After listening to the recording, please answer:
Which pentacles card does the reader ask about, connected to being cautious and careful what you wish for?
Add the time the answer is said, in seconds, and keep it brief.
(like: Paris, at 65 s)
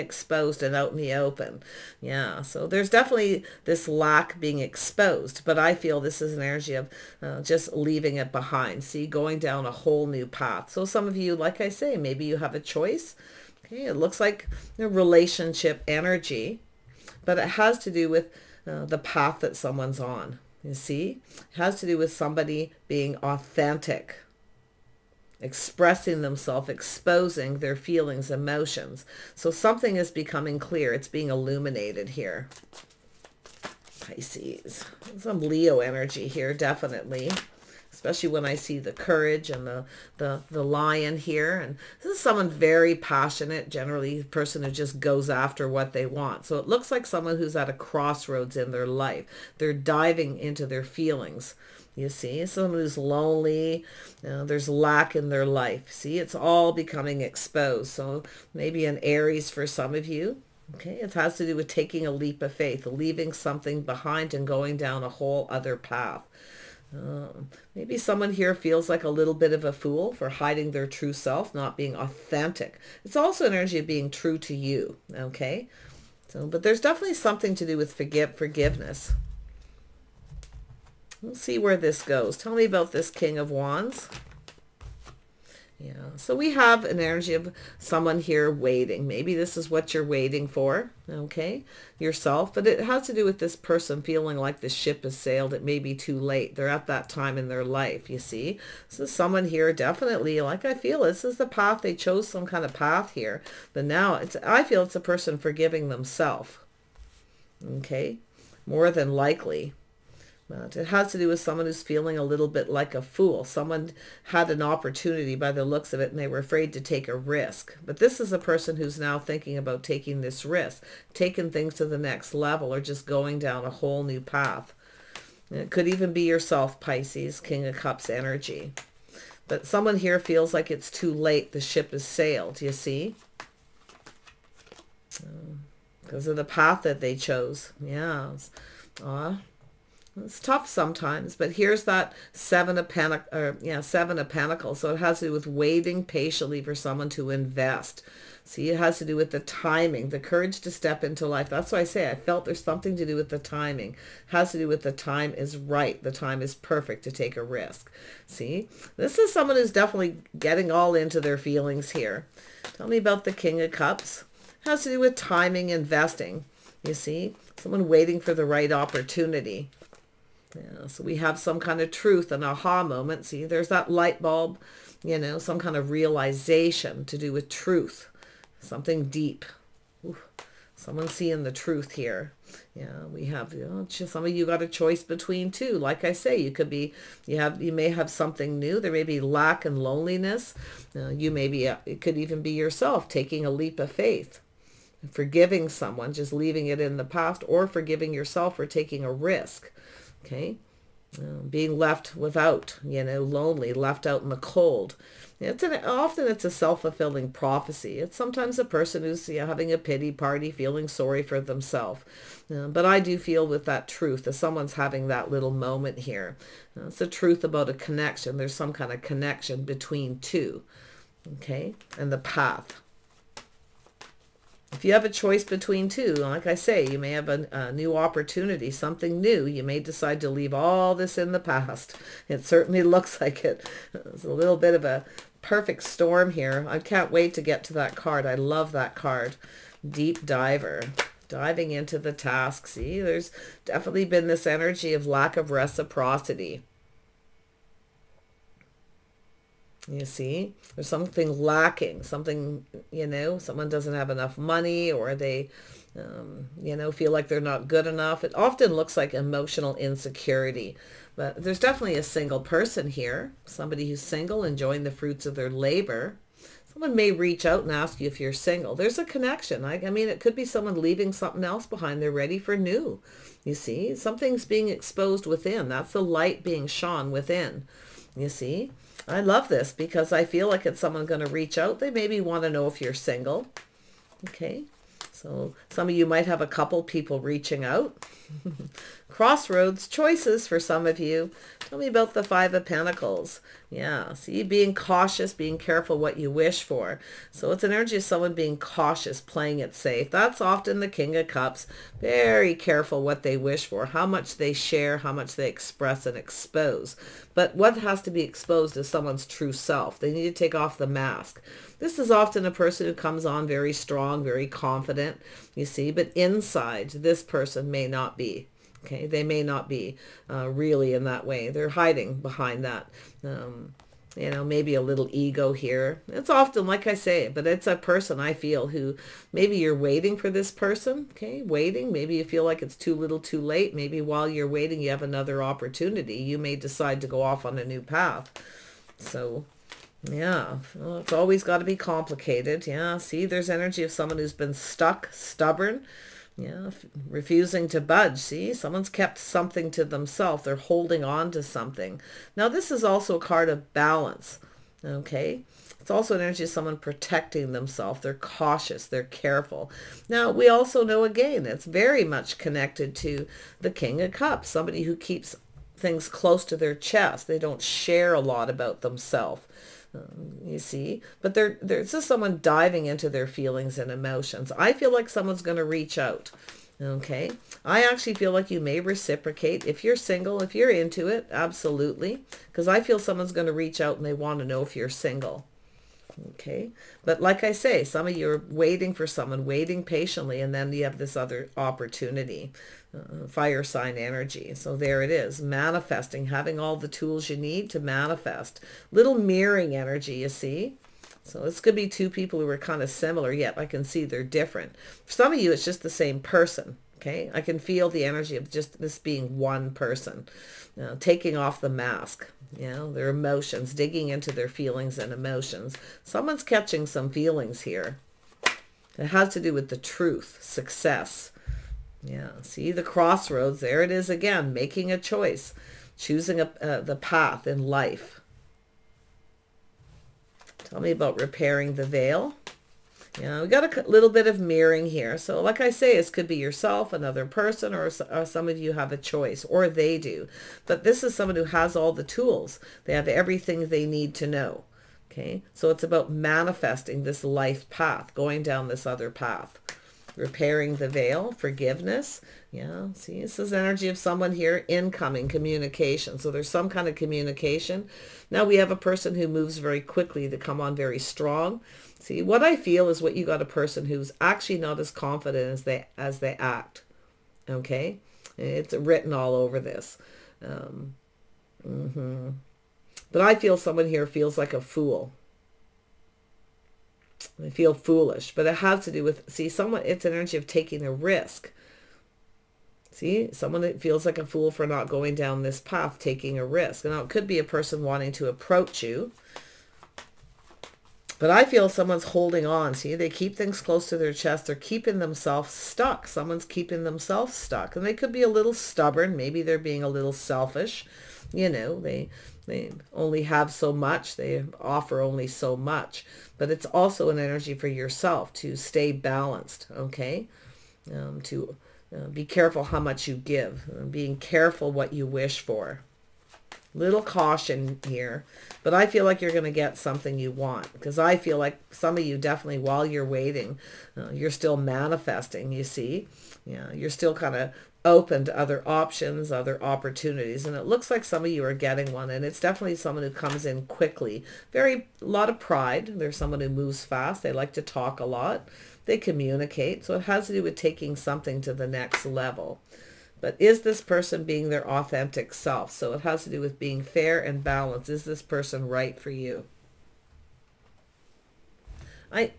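Five of Pentacles, at 292 s.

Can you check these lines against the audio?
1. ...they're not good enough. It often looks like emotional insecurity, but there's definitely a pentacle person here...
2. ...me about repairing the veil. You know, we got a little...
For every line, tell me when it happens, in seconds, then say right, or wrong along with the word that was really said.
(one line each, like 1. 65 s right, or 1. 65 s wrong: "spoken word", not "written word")
1. 257 s wrong: "single", not "pentacle"
2. 430 s right.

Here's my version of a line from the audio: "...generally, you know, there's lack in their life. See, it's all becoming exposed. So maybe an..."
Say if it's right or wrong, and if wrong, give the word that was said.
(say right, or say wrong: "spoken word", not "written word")
wrong: "lonely", not "generally".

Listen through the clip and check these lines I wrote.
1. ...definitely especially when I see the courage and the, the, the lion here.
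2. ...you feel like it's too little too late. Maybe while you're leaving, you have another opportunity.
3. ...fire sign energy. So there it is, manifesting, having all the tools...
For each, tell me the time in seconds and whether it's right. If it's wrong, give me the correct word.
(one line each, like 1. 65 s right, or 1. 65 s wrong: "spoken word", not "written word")
1. 36 s right
2. 332 s wrong: "waiting", not "leaving"
3. 393 s right.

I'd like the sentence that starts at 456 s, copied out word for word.
So there's some kind of communication.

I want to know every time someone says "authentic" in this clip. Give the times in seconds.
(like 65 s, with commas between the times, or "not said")
23 s, 71 s, 544 s.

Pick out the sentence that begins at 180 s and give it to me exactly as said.
Ooh, someone seeing the truth here.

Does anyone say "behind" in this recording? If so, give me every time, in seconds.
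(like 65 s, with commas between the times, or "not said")
8 s, 63 s, 271 s, 322 s.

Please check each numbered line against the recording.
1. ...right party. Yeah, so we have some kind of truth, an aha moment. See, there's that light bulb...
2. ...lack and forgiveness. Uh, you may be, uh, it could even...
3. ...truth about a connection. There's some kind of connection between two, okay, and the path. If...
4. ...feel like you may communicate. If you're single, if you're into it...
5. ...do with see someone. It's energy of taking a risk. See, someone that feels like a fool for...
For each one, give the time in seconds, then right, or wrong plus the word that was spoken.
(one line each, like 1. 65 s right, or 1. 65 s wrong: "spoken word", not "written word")
1. 168 s wrong: "opportunity", not "party"
2. 189 s wrong: "loneliness", not "forgiveness"
3. 217 s right
4. 378 s wrong: "reciprocate", not "communicate"
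5. 478 s right.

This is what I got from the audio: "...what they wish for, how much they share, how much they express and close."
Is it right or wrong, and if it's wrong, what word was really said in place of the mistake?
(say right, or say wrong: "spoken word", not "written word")
wrong: "expose", not "close".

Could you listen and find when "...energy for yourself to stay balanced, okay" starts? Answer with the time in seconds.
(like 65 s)
507 s.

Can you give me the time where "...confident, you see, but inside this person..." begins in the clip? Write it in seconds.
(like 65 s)
314 s.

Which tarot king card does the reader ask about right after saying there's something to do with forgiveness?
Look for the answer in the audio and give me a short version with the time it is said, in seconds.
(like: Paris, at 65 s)
King of Wands, at 83 s.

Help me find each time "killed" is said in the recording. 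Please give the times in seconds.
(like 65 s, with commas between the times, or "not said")
not said.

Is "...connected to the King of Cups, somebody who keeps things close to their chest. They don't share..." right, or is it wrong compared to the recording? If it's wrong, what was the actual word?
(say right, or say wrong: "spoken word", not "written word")
right.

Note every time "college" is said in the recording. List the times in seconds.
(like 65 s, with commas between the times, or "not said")
not said.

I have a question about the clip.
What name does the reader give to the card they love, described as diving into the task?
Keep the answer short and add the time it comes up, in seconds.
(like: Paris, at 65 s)
Deep Diver, at 239 s.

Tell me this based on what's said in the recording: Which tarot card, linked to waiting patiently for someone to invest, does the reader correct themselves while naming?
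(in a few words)
Seven of Pentacles.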